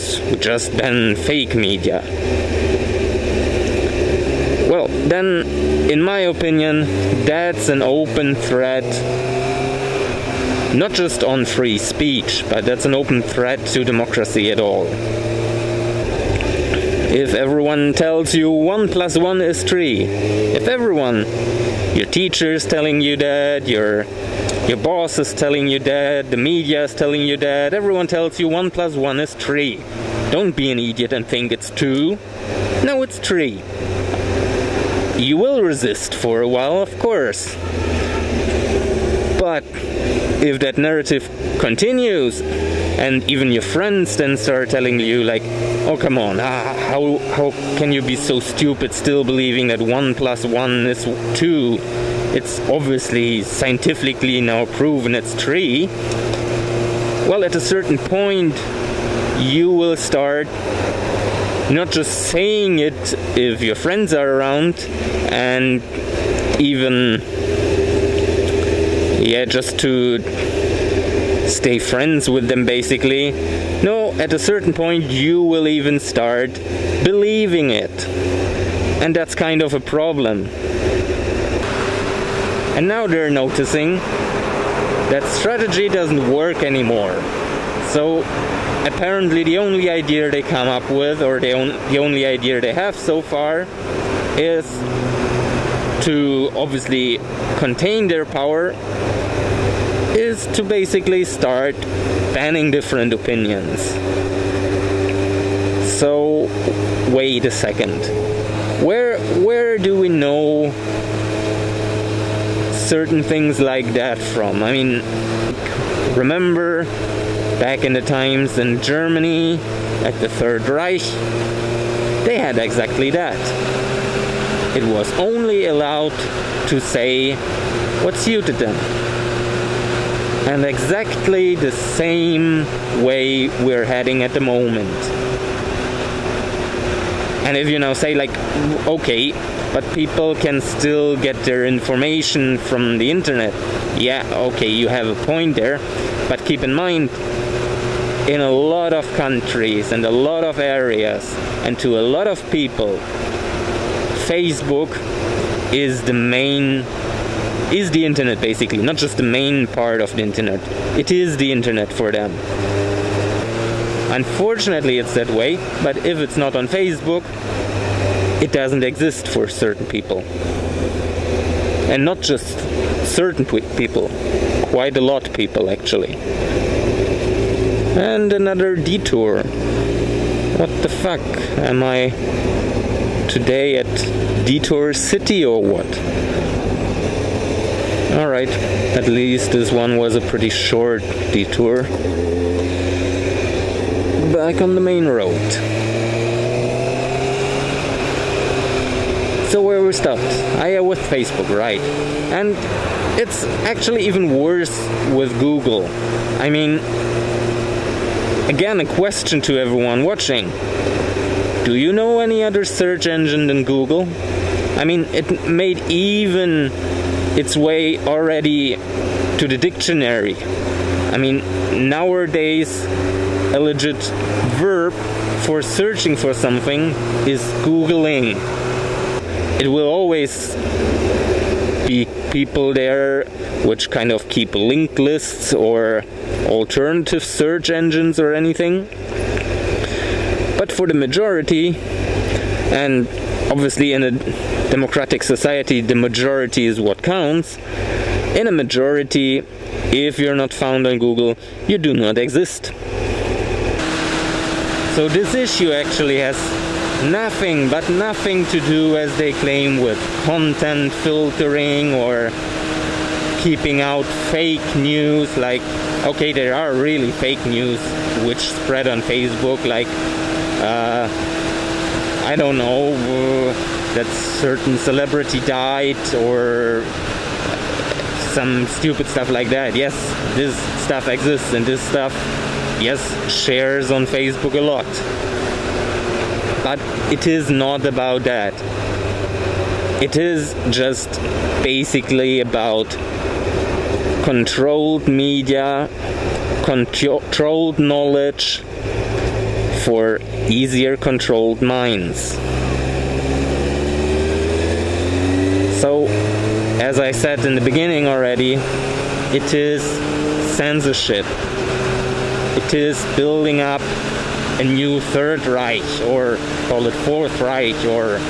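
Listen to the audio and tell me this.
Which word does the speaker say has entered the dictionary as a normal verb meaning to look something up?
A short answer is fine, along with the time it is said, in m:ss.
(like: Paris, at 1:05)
Googling, at 3:47.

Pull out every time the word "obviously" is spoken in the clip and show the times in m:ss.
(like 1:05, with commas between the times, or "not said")
0:52, 1:36, 4:03.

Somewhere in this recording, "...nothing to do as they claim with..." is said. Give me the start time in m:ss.
4:17.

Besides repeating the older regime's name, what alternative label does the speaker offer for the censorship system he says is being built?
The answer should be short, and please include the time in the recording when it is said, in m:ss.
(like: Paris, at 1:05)
Fourth Reich, at 5:17.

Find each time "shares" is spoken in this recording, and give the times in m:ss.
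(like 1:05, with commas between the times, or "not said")
4:43.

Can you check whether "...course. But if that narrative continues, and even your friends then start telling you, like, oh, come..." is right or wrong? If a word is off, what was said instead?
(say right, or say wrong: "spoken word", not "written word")
right.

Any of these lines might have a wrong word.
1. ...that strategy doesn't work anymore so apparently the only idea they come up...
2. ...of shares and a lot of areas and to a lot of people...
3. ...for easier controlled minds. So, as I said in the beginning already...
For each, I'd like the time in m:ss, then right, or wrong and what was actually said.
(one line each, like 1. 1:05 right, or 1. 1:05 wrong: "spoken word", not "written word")
1. 1:25 right
2. 2:28 wrong: "countries", not "shares"
3. 4:59 right.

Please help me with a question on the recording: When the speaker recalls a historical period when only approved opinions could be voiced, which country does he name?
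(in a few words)
Germany.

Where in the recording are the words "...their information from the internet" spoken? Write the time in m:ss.
2:21.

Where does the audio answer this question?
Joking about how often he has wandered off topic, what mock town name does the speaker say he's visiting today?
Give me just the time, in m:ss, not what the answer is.
3:04.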